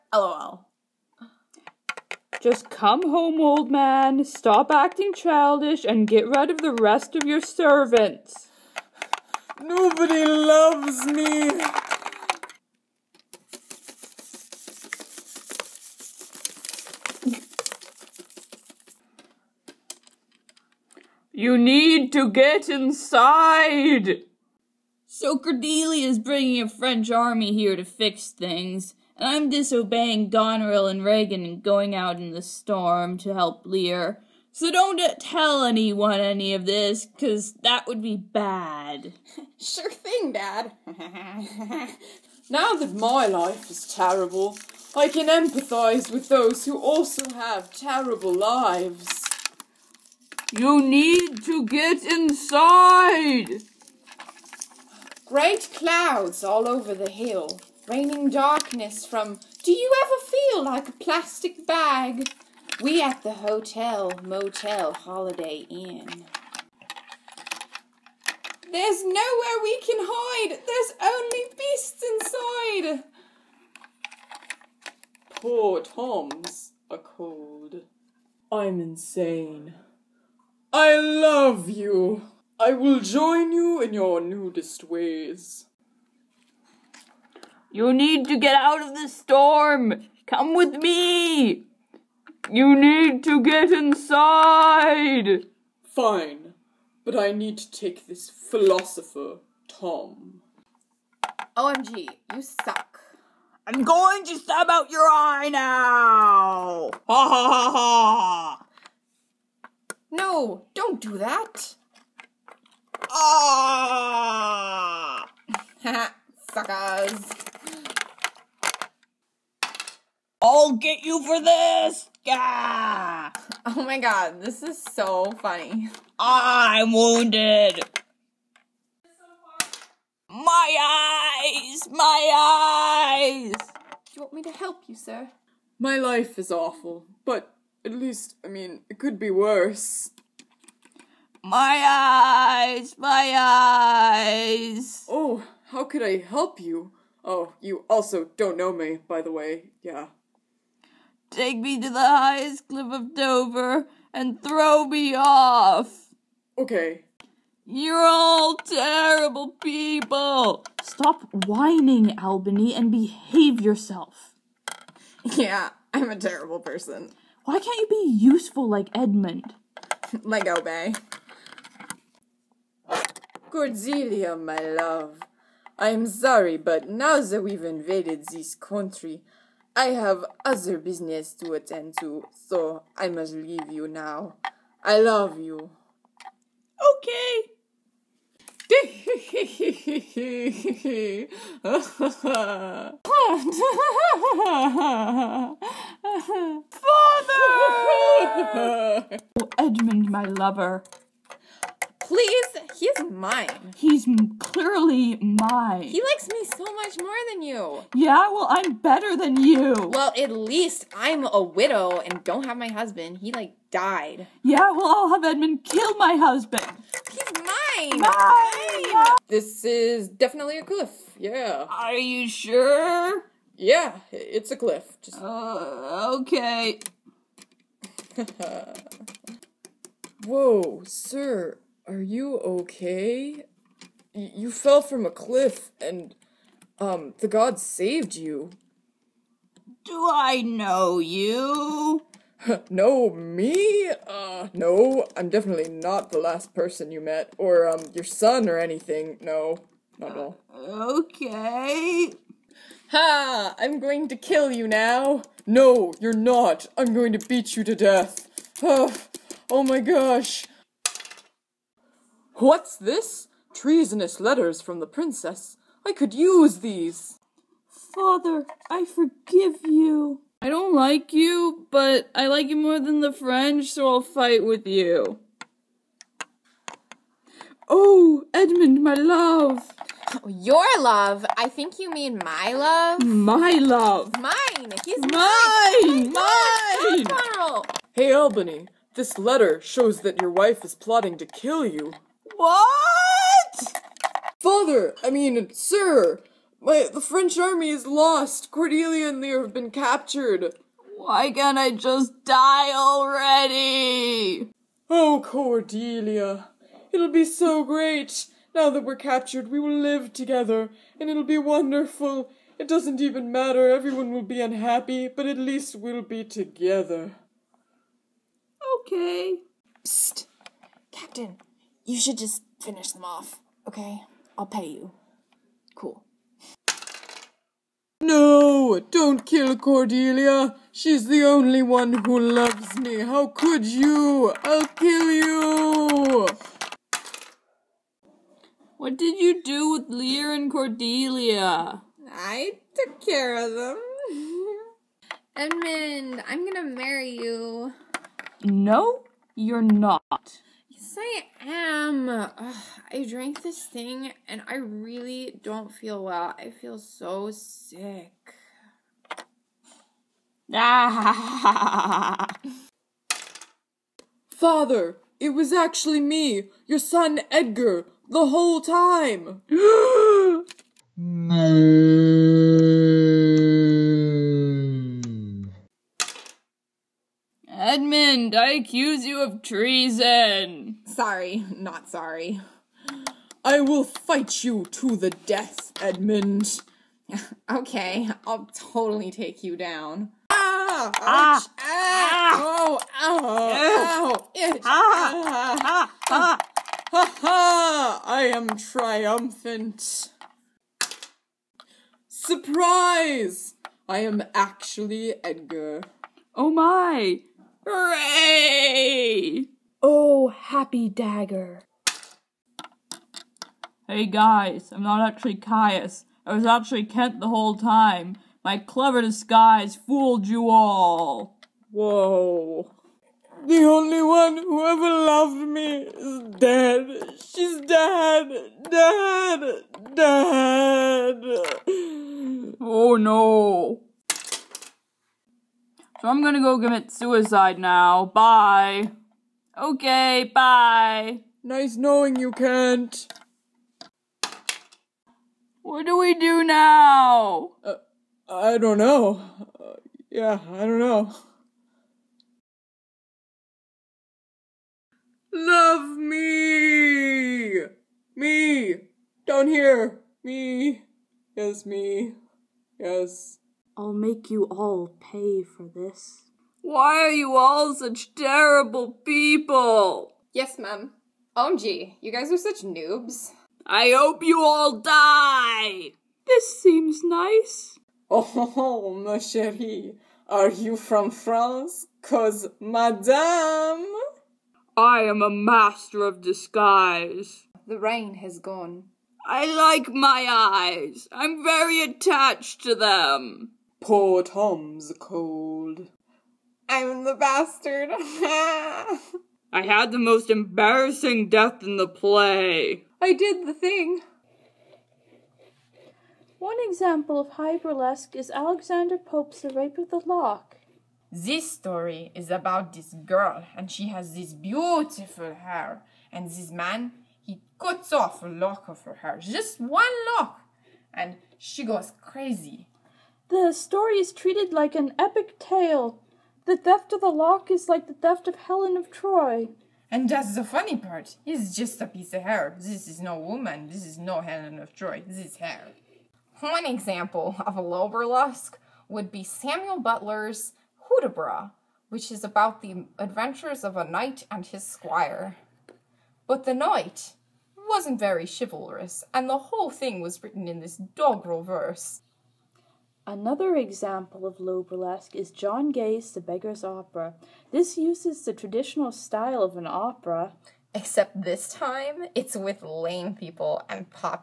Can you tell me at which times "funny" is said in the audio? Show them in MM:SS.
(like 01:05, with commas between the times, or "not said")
02:05, 08:50.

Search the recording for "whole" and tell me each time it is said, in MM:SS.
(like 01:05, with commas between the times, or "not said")
06:08, 06:57, 09:09.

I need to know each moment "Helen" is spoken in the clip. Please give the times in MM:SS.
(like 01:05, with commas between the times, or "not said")
08:48, 08:54.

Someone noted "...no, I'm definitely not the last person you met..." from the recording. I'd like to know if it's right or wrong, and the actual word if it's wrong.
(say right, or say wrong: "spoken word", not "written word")
right.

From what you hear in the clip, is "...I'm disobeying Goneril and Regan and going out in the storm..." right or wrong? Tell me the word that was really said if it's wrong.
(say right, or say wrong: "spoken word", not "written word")
right.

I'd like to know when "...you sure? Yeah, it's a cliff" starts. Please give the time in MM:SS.
03:41.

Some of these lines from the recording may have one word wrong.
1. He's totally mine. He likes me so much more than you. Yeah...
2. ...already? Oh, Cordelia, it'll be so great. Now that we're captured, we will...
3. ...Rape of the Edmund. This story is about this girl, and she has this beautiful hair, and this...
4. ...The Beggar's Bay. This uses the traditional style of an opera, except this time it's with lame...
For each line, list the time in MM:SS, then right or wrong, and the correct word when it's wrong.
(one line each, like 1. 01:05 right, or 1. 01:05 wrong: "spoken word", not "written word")
1. 03:23 wrong: "clearly", not "totally"
2. 05:02 right
3. 08:29 wrong: "Lock", not "Edmund"
4. 09:16 wrong: "Opera", not "Bay".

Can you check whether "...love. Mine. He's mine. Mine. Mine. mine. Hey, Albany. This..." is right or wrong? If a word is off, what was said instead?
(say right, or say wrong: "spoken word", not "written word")
right.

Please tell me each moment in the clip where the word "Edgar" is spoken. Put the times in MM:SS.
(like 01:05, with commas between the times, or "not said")
06:07, 06:45.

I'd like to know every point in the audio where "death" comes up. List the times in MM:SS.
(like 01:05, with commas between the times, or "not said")
04:17, 06:25, 08:21.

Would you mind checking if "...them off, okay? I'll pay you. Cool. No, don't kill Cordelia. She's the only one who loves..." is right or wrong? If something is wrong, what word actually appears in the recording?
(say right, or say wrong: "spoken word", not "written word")
right.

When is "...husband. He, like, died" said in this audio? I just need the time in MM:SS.
03:32.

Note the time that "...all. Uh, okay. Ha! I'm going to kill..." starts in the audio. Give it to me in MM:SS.
04:10.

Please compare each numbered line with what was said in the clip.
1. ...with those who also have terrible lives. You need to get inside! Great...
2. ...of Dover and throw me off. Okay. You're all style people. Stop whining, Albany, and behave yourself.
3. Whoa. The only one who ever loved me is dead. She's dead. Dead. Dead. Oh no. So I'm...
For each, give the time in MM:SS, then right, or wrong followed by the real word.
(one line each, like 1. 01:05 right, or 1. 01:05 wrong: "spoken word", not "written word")
1. 00:46 right
2. 02:32 wrong: "terrible", not "style"
3. 07:01 right.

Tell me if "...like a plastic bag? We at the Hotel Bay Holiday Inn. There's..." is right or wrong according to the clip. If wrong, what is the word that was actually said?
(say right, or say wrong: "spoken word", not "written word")
wrong: "Motel", not "Bay".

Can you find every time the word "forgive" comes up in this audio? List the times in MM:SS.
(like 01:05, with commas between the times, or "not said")
04:28.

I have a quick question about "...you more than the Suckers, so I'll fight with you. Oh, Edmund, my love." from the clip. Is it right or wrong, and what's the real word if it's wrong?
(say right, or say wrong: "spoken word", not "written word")
wrong: "French", not "Suckers".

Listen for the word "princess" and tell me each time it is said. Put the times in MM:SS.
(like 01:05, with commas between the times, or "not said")
04:24.